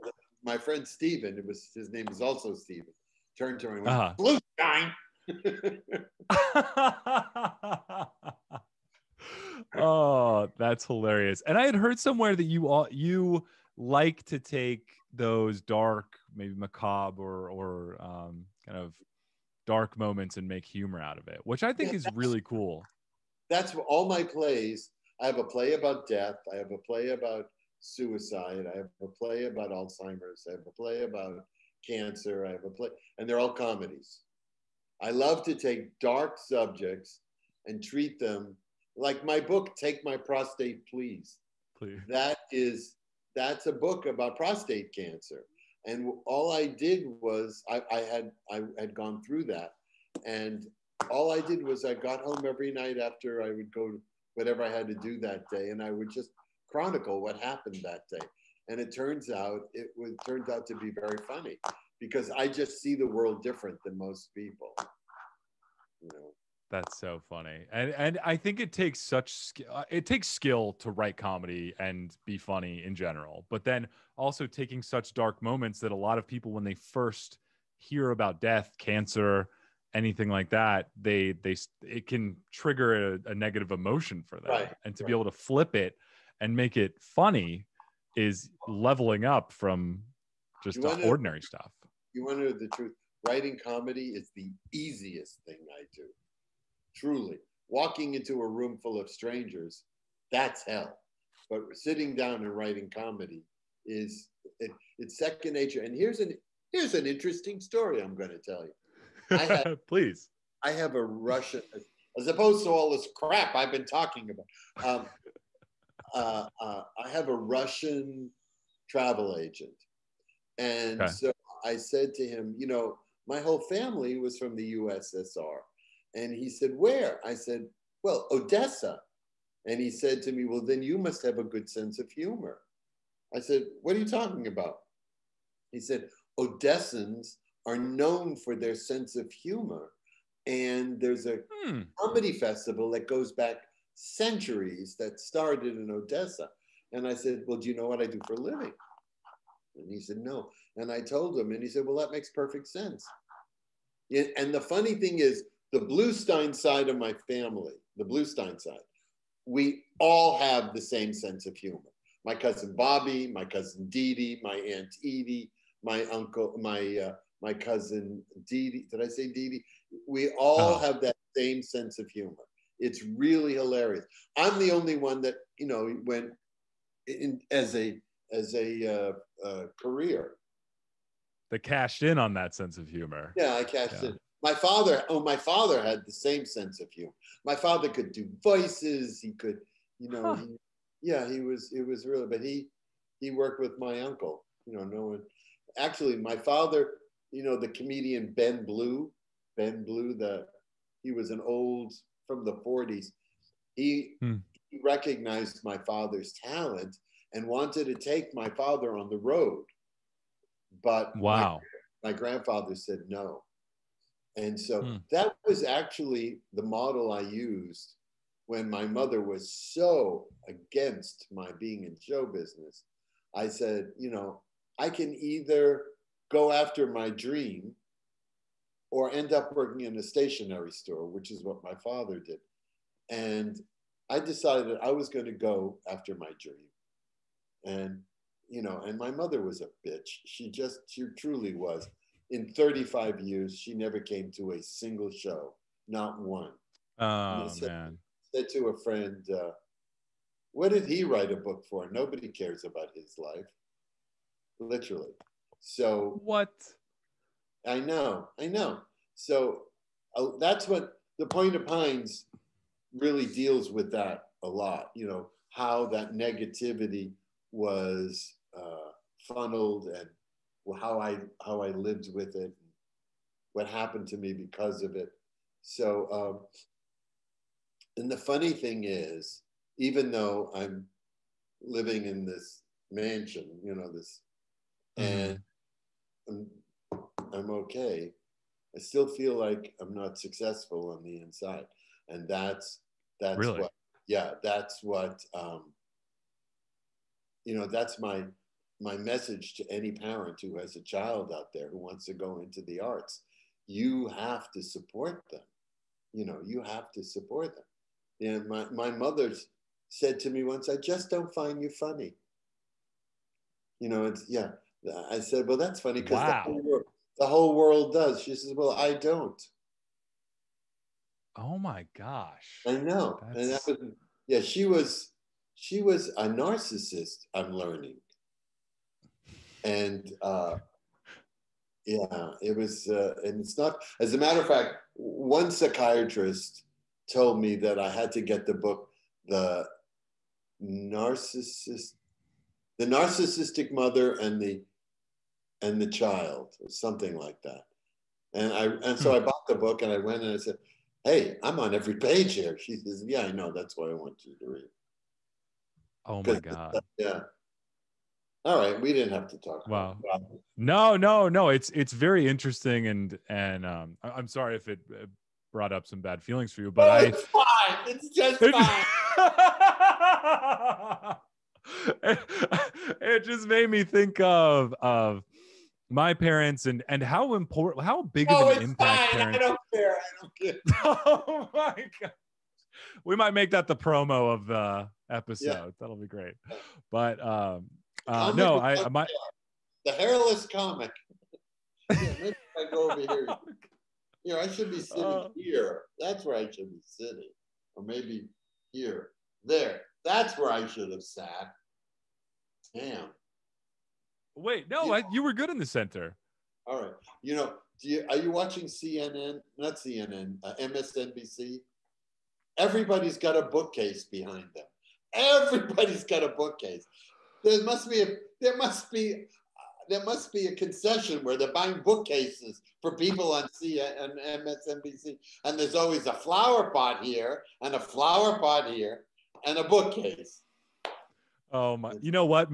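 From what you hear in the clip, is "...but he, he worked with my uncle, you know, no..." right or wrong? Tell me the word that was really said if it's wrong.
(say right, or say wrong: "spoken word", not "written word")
right.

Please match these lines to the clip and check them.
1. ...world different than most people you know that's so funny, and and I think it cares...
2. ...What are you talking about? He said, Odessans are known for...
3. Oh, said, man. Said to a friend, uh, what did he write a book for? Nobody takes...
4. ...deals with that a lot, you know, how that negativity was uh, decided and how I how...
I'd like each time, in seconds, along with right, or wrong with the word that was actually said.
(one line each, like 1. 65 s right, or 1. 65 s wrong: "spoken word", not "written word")
1. 63 s wrong: "takes", not "cares"
2. 133 s right
3. 246 s wrong: "cares", not "takes"
4. 263 s wrong: "funneled", not "decided".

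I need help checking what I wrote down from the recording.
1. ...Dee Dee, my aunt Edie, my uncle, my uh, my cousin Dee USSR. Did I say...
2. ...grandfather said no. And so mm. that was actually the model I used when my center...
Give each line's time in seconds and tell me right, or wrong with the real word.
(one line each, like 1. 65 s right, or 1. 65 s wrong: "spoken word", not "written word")
1. 163 s wrong: "Dee", not "USSR"
2. 212 s wrong: "mother", not "center".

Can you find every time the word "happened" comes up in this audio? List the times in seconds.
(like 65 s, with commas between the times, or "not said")
57 s, 273 s.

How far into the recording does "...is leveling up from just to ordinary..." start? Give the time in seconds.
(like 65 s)
88 s.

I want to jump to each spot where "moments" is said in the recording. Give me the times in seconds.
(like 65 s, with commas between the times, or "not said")
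19 s, 75 s.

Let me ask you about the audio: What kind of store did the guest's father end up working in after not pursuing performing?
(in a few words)
Stationery store.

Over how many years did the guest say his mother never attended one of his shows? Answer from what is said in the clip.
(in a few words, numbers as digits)
35.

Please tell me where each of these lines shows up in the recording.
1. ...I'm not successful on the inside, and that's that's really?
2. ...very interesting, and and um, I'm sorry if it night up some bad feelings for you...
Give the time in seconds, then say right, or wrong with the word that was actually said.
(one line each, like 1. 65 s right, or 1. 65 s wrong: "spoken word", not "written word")
1. 289 s right
2. 361 s wrong: "brought", not "night".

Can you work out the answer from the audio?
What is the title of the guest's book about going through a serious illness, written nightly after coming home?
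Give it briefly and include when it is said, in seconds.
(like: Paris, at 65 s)
Take My Prostate Please, at 39 s.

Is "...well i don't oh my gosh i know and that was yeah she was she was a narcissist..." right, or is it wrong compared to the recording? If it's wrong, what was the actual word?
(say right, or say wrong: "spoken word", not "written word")
right.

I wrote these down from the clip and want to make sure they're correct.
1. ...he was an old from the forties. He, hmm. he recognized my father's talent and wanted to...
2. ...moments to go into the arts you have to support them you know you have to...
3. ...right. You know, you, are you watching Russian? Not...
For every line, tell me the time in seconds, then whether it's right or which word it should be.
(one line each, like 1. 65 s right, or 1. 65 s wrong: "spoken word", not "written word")
1. 201 s right
2. 301 s wrong: "wants", not "moments"
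3. 406 s wrong: "CNN", not "Russian".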